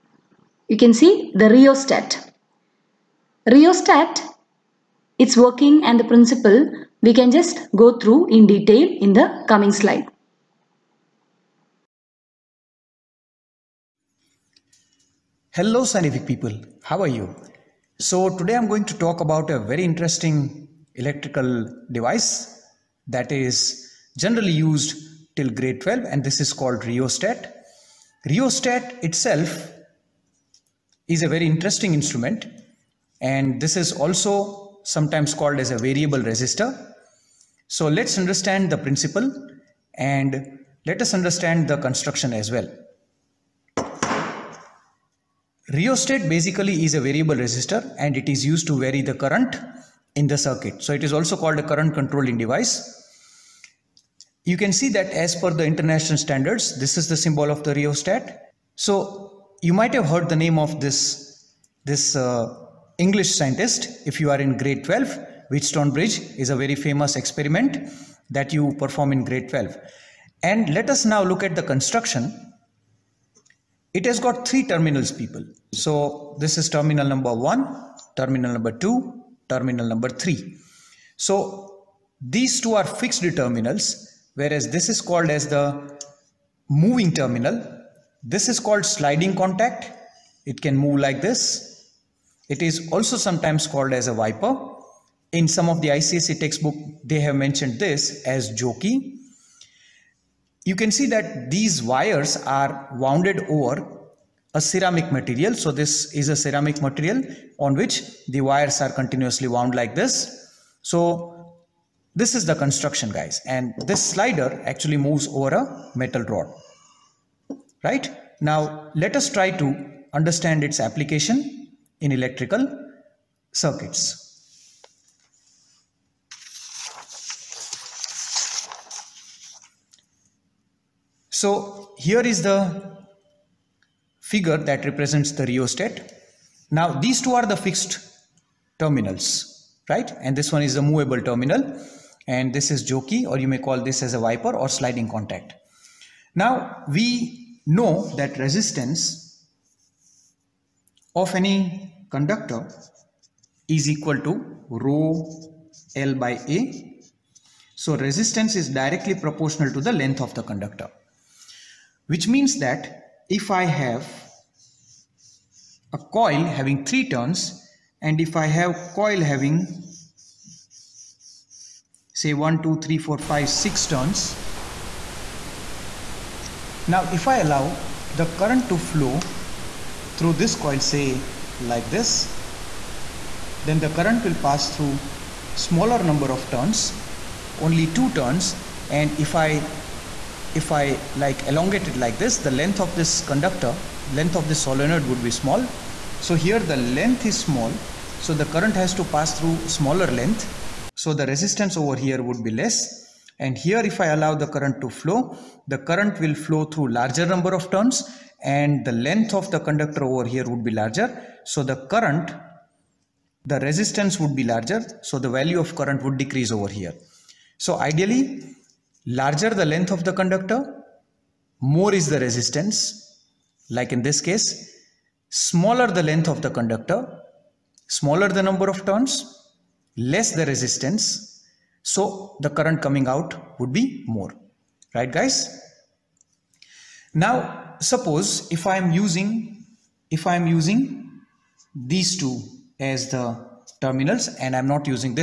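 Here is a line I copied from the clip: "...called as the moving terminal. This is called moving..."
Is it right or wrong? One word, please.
wrong.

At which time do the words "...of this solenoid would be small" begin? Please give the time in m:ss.
3:14.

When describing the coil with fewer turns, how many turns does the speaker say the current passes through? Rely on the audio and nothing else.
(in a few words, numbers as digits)
2.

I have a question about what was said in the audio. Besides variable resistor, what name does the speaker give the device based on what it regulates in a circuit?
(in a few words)
current controlling device.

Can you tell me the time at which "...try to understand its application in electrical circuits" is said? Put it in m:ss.
1:59.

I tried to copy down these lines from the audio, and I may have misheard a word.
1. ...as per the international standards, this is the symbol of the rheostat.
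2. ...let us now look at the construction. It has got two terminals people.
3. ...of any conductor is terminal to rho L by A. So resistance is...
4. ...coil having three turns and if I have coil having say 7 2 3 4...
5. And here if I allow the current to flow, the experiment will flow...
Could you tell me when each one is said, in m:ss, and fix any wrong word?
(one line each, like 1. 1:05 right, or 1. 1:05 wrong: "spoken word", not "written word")
1. 0:55 right
2. 1:10 wrong: "three", not "two"
3. 2:31 wrong: "equal", not "terminal"
4. 2:45 wrong: "1", not "7"
5. 3:23 wrong: "current", not "experiment".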